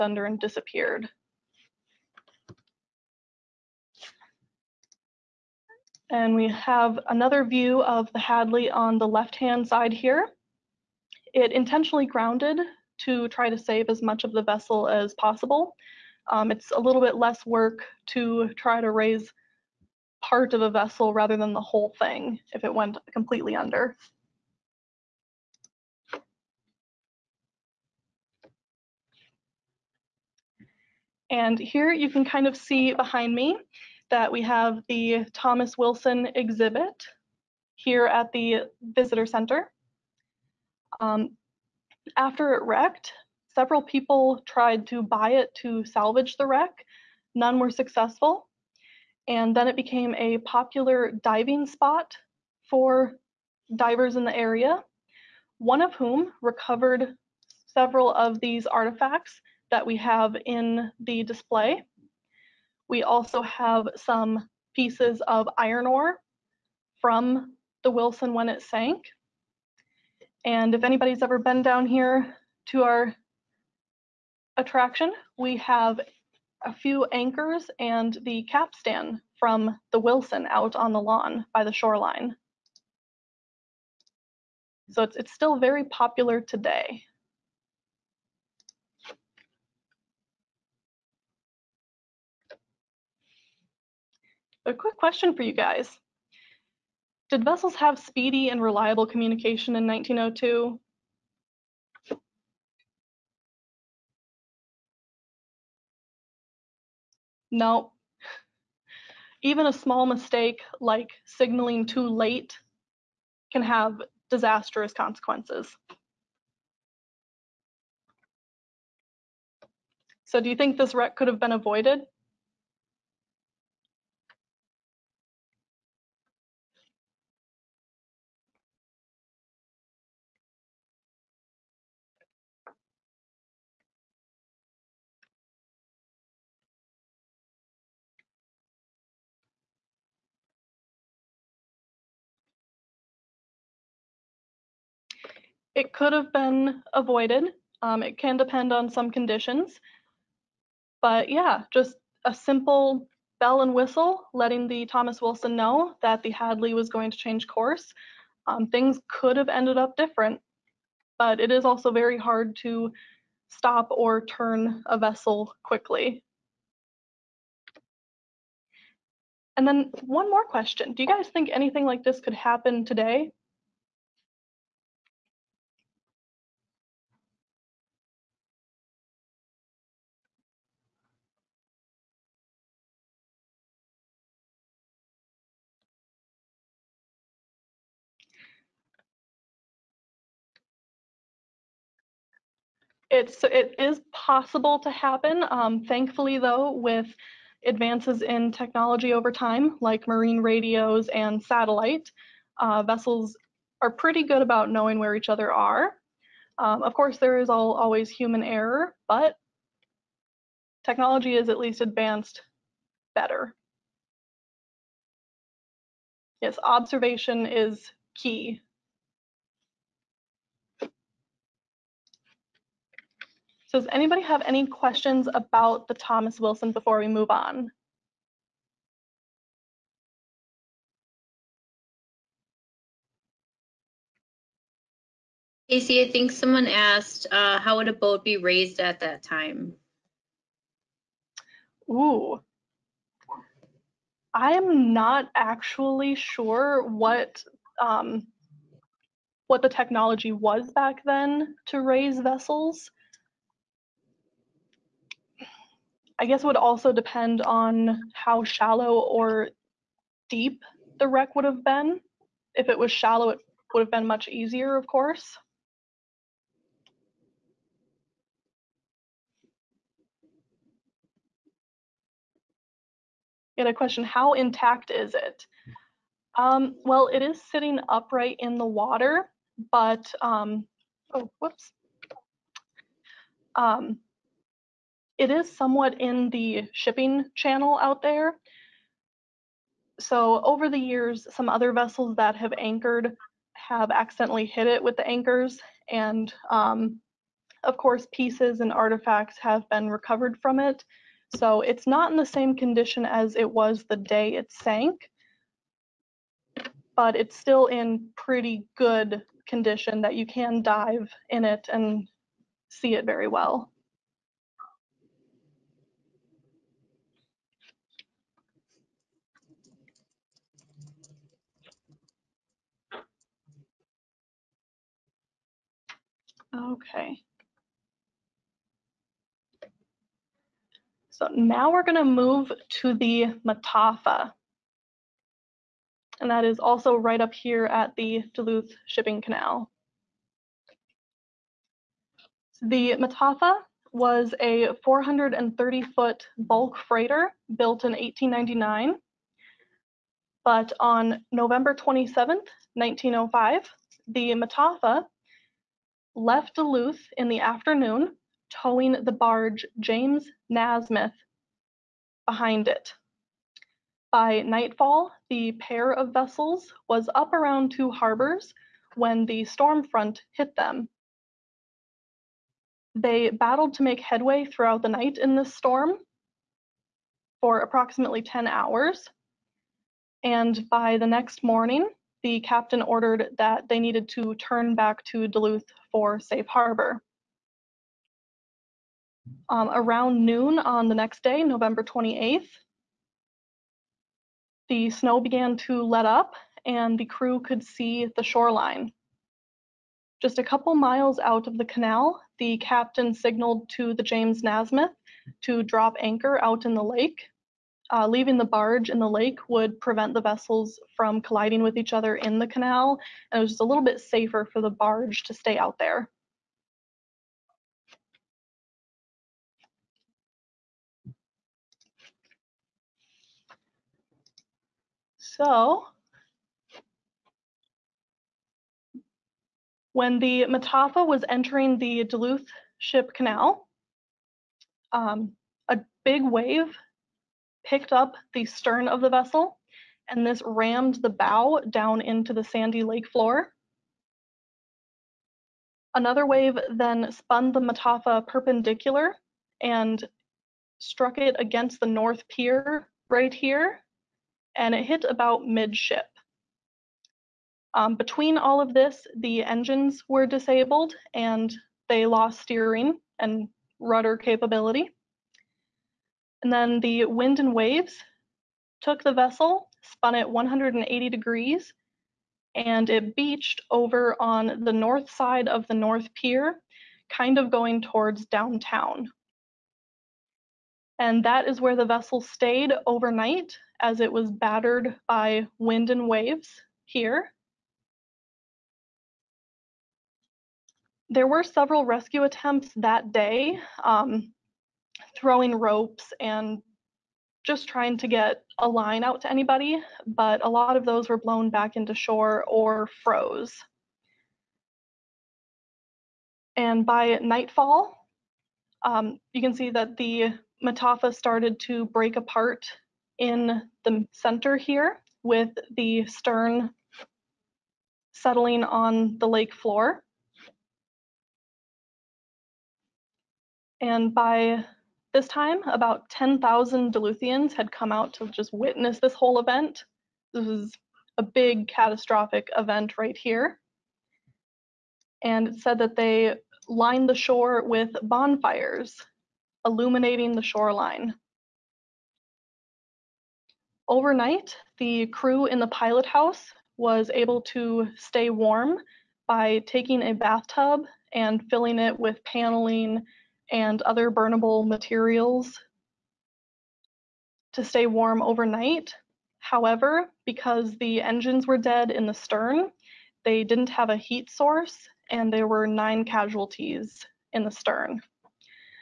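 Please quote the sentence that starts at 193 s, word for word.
it's it is possible to happen.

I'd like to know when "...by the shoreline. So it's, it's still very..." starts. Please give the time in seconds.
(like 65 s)
81 s.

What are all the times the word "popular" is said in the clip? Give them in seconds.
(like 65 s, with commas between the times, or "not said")
50 s, 85 s.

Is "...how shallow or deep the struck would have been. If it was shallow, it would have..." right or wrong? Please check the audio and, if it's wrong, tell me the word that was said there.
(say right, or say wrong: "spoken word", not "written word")
wrong: "wreck", not "struck".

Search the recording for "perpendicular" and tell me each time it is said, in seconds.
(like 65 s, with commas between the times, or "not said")
448 s.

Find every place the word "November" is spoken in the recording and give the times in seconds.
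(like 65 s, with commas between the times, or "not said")
351 s, 391 s.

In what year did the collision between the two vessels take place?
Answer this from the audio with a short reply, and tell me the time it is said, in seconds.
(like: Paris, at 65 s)
1902, at 99 s.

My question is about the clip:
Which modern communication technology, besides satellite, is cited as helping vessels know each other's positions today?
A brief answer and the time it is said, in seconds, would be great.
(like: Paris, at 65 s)
marine radios, at 200 s.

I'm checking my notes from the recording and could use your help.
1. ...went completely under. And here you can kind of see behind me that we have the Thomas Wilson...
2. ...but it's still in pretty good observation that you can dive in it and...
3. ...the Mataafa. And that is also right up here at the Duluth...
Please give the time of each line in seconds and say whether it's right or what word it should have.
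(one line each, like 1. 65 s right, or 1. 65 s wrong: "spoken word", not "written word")
1. 22 s right
2. 306 s wrong: "condition", not "observation"
3. 332 s right.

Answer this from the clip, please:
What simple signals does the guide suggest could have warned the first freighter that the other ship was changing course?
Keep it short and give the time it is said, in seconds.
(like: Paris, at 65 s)
bell and whistle, at 153 s.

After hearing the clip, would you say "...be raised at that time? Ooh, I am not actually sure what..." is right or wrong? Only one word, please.
right.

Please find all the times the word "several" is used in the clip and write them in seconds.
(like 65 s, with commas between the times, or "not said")
43 s, 57 s, 491 s.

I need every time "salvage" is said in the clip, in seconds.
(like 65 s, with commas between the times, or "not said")
45 s.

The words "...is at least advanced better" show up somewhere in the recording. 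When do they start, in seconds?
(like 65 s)
211 s.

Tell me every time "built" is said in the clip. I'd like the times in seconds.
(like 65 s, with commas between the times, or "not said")
347 s.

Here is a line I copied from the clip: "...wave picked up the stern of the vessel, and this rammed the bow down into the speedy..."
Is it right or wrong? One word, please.
wrong.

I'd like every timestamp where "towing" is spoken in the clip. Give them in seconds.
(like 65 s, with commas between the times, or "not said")
358 s.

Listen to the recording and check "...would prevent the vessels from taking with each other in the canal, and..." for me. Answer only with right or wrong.
wrong.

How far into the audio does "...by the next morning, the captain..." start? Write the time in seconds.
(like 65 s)
380 s.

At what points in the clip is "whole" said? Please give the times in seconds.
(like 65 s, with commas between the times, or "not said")
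21 s, 529 s.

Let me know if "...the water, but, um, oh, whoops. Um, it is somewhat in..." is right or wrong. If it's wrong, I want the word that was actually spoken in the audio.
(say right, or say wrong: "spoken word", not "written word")
right.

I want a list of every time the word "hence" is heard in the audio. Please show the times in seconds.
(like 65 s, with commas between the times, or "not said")
not said.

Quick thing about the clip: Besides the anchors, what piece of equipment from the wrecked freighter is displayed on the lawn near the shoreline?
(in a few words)
capstan.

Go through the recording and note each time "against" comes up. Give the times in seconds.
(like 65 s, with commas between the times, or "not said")
451 s.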